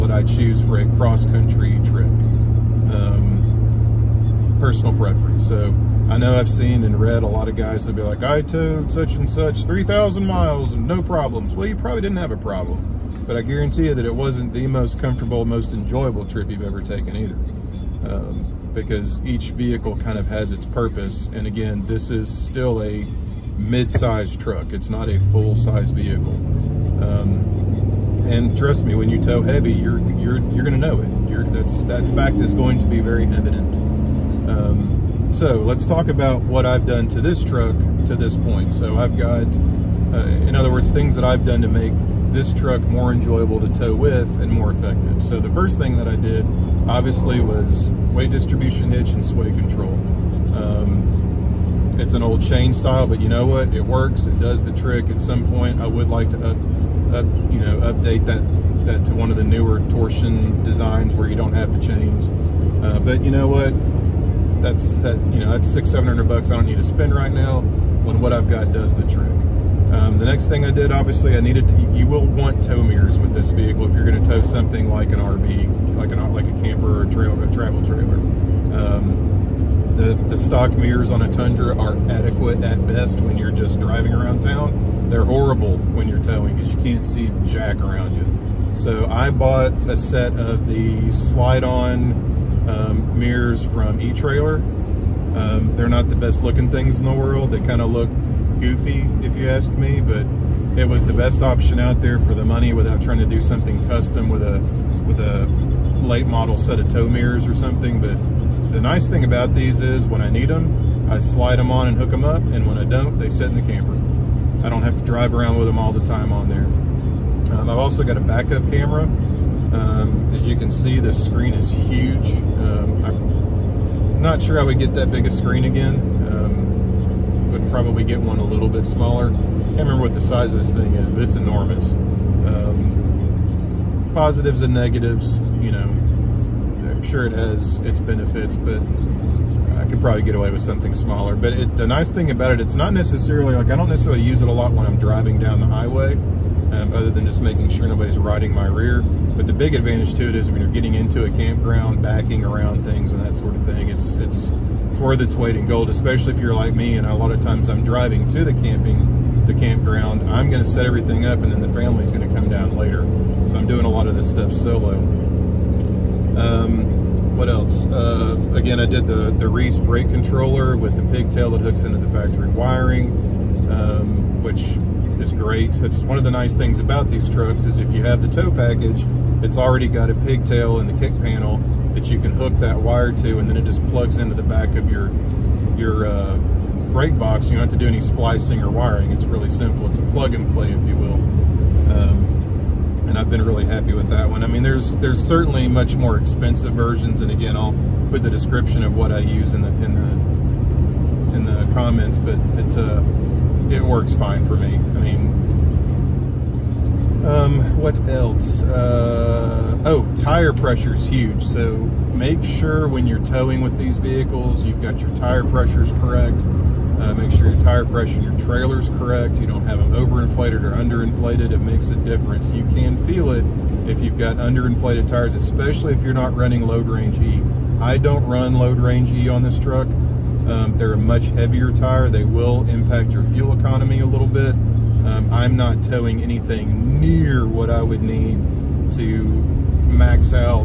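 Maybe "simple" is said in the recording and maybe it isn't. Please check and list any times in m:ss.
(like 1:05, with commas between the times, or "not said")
3:09.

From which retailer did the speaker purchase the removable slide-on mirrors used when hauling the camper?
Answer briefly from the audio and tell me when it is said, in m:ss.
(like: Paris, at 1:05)
E-Trailer, at 1:33.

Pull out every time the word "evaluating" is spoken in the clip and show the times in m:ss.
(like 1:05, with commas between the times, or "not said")
not said.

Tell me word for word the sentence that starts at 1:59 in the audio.
Um, as you can see, the screen is huge.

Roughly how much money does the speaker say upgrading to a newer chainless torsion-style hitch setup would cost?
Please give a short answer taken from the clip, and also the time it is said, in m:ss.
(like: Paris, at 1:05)
600 to 700 dollars, at 1:05.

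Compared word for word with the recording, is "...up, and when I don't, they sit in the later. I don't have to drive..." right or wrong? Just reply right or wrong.
wrong.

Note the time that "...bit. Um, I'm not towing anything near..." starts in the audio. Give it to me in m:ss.
3:54.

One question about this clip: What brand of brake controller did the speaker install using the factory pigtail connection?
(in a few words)
Reese.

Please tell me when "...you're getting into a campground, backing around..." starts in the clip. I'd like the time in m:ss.
2:30.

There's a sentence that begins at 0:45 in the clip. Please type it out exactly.
So the first thing that I did, obviously, was weight distribution hitch and sway control.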